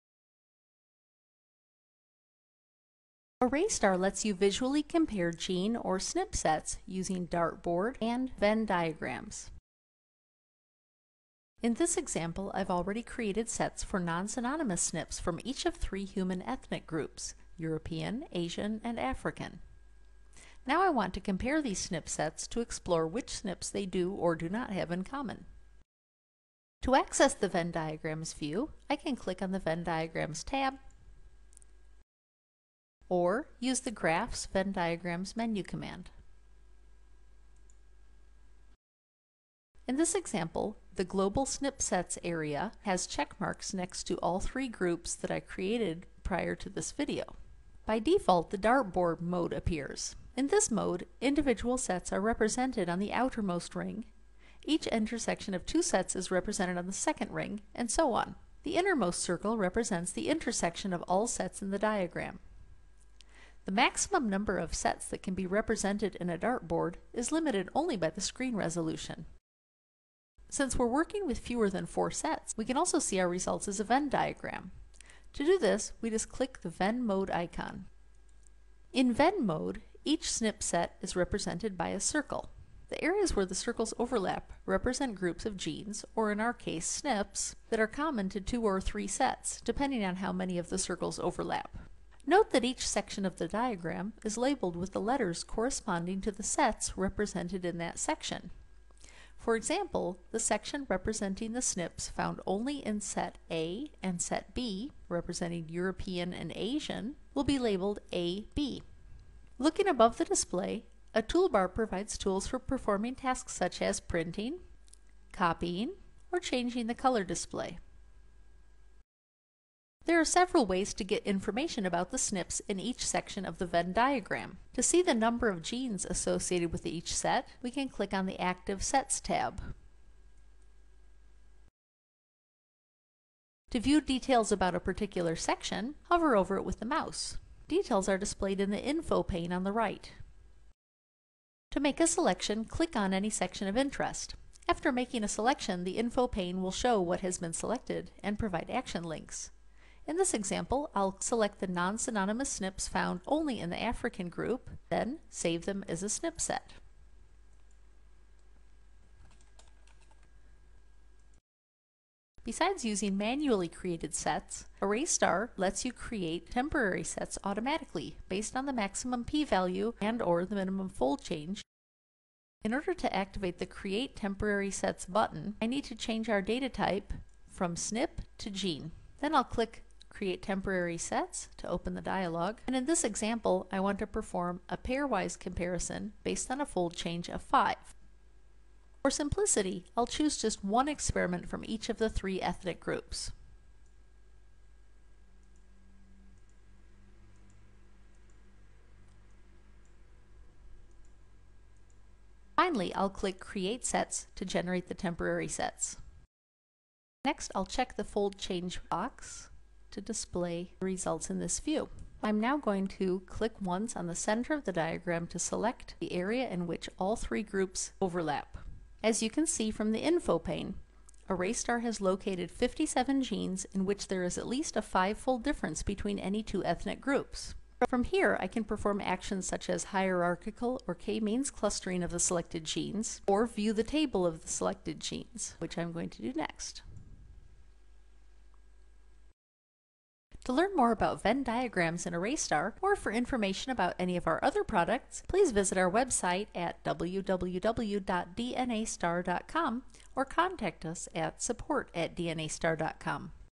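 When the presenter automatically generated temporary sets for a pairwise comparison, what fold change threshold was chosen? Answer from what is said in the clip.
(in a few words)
5.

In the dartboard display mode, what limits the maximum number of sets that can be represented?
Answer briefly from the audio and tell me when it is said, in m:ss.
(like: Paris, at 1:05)
Screen resolution, at 1:08.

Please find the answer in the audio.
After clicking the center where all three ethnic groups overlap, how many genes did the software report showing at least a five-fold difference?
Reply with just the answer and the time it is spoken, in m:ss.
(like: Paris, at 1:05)
57, at 3:42.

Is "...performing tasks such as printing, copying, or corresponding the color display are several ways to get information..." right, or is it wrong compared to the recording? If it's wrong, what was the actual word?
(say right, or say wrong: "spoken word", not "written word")
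wrong: "changing", not "corresponding".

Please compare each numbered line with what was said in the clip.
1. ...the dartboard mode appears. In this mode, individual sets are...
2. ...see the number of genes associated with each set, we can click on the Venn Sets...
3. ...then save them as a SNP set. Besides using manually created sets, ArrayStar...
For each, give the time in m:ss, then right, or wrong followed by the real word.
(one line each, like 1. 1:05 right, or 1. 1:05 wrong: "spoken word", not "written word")
1. 0:48 right
2. 2:04 wrong: "Active", not "Venn"
3. 2:34 right.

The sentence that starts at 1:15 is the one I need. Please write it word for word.
To do this, we just click the Venn mode icon.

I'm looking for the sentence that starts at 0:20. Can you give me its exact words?
Now I want to compare these SNP sets to explore which SNPs they do or do not have in common.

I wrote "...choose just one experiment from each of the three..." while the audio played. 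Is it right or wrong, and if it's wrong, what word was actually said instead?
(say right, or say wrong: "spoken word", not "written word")
right.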